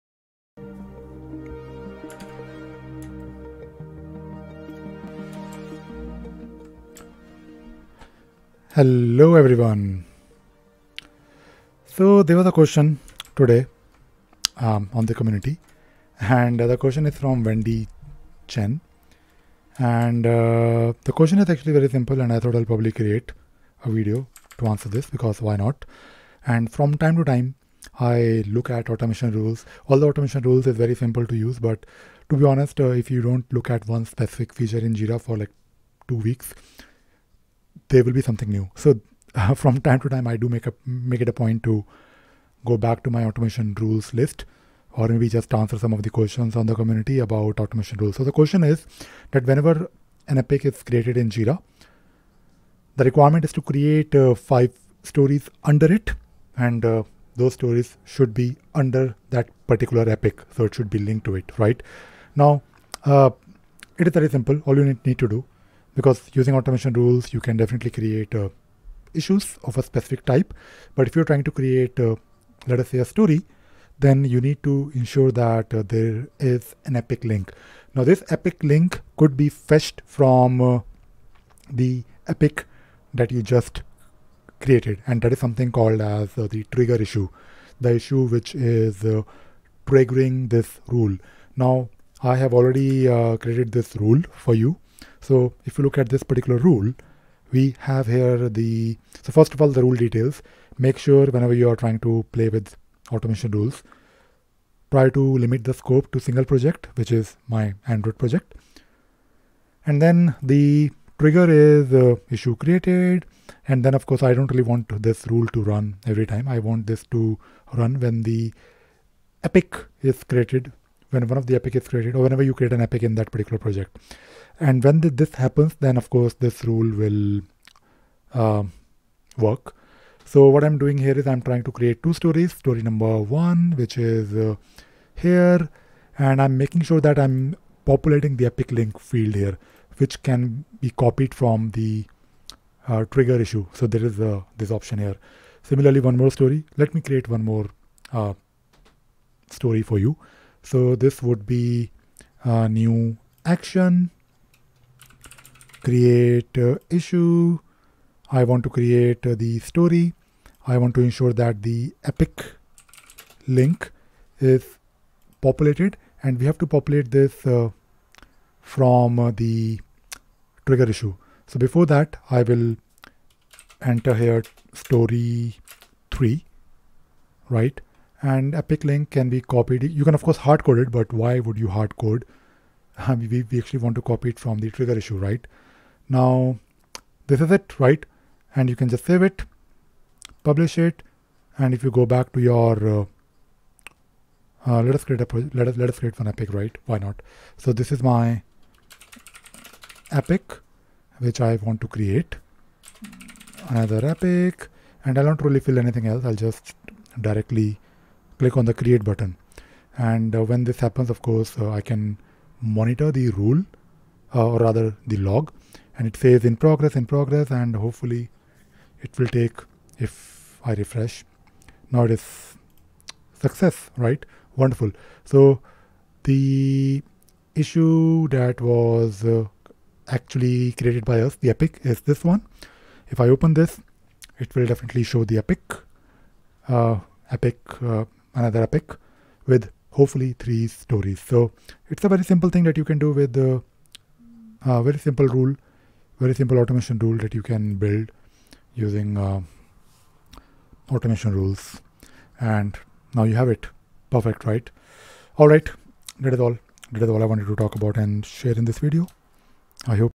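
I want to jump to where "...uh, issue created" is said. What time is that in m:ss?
1:51.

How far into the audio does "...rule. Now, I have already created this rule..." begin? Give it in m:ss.
1:30.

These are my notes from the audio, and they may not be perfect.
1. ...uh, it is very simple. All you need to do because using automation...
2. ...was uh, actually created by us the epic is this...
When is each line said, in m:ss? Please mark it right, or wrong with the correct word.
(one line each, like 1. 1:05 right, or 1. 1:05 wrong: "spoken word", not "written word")
1. 1:03 right
2. 3:48 right.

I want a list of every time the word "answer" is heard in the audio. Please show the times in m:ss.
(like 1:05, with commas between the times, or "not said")
0:24, 0:45.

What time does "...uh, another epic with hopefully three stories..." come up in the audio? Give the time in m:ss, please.
3:57.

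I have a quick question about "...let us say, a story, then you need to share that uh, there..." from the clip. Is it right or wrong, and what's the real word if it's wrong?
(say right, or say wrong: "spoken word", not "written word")
wrong: "ensure", not "share".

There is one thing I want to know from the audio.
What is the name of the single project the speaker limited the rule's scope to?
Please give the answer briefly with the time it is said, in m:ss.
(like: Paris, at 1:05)
Android, at 1:47.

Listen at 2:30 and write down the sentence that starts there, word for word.
So this would be a new action create issue.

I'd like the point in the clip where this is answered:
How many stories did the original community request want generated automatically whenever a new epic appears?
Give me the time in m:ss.
0:54.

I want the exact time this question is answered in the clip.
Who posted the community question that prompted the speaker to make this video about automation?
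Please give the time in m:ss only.
0:17.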